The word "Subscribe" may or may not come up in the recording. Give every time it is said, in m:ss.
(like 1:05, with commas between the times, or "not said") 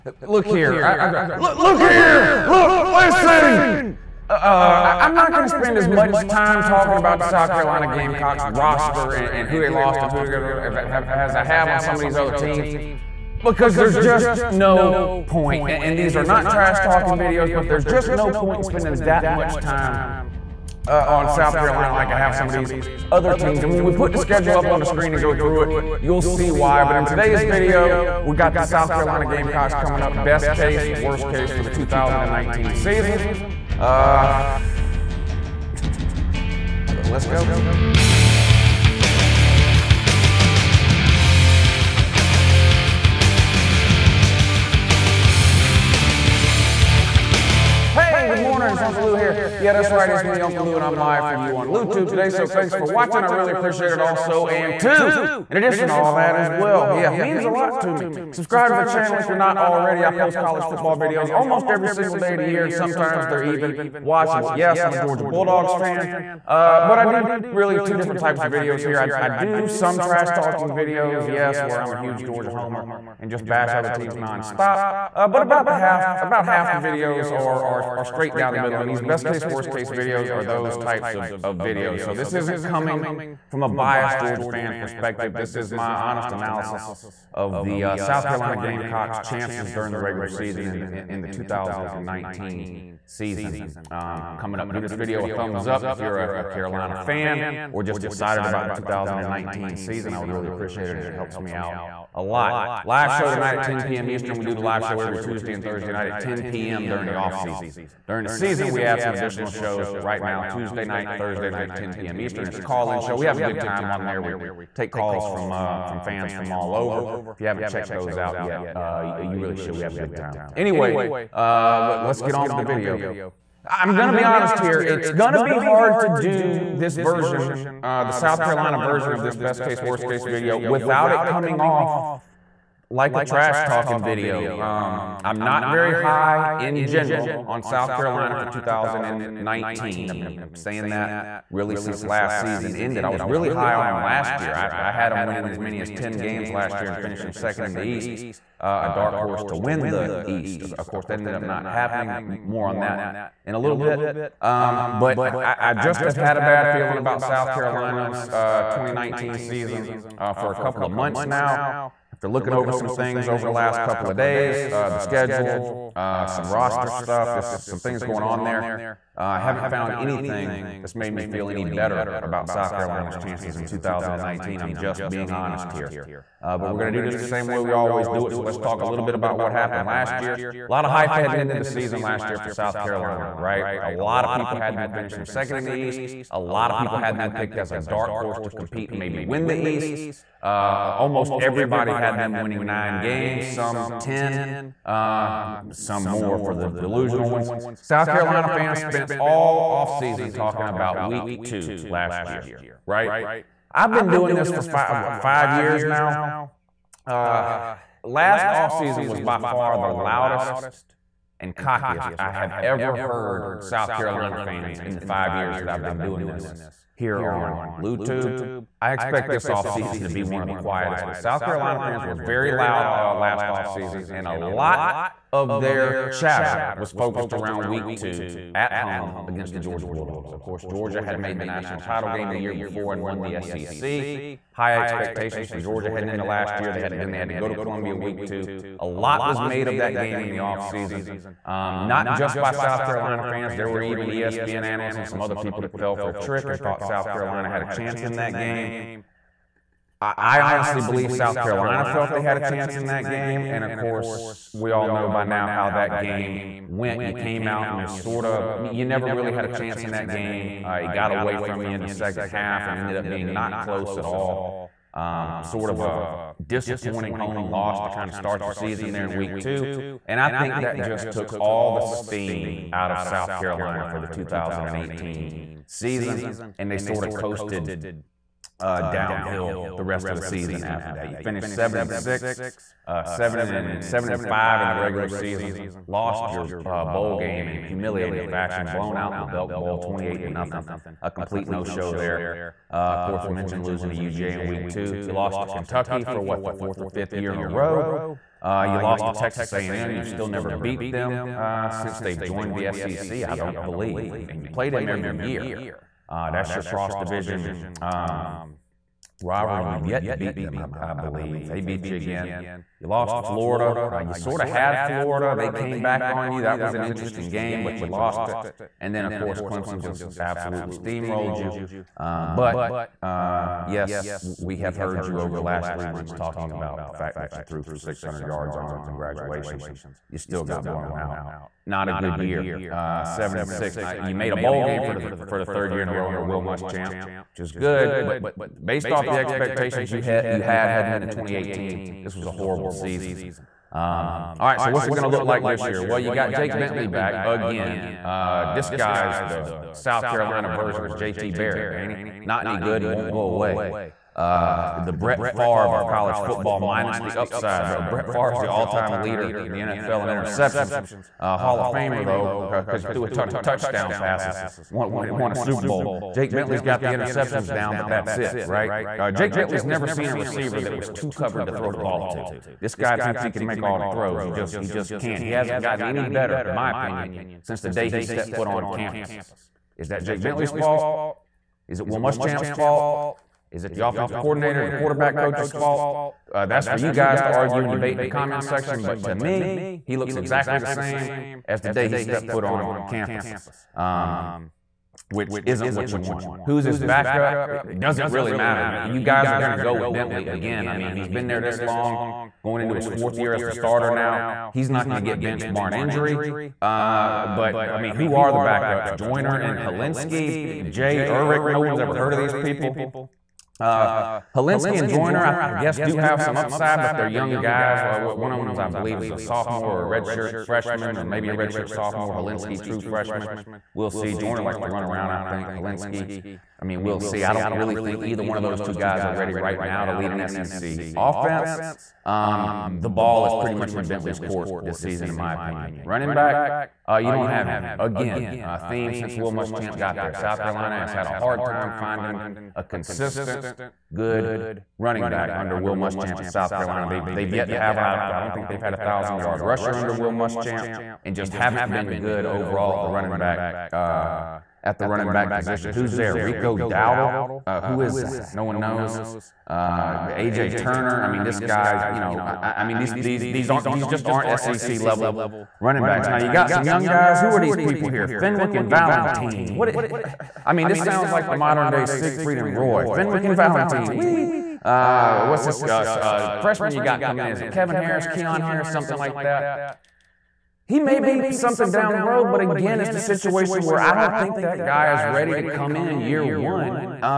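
0:58.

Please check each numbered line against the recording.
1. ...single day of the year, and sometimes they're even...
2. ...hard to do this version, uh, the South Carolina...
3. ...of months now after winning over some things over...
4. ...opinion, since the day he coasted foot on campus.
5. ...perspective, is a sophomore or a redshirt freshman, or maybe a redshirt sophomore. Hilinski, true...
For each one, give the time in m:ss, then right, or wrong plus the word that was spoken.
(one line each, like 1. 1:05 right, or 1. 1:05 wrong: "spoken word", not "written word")
1. 1:01 right
2. 2:05 right
3. 2:40 wrong: "looking", not "winning"
4. 6:16 wrong: "stepped", not "coasted"
5. 6:58 wrong: "believe", not "perspective".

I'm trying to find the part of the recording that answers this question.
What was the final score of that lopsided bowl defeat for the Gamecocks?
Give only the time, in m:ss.
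4:49.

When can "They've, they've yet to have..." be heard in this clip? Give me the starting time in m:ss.
7:26.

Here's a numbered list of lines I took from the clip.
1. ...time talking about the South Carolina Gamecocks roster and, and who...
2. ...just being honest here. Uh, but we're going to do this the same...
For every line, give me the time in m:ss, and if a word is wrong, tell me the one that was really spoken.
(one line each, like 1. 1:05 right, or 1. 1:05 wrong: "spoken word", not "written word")
1. 0:06 right
2. 2:54 right.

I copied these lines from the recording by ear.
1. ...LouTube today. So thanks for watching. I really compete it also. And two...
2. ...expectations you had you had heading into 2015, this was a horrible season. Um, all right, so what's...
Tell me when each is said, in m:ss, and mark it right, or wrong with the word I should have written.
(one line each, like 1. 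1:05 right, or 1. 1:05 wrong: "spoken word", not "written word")
1. 0:51 wrong: "appreciate", not "compete"
2. 5:39 wrong: "2018", not "2015".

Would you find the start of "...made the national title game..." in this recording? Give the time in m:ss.
3:51.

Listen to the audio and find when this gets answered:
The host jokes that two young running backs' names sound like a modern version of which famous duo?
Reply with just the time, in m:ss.
7:51.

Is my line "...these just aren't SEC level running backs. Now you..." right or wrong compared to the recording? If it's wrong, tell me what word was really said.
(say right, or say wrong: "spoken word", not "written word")
right.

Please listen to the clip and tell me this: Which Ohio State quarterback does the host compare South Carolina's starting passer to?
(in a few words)
JT Barrett.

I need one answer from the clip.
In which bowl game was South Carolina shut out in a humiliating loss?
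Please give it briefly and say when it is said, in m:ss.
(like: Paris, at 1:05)
Belk Bowl, at 4:49.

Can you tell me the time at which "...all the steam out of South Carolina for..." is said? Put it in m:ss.
4:31.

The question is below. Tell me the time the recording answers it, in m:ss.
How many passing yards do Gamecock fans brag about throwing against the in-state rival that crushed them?
5:27.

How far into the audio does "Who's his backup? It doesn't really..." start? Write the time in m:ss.
6:36.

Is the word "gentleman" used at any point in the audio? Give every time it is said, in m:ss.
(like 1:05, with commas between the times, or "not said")
not said.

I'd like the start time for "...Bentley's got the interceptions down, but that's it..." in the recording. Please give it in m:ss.
6:06.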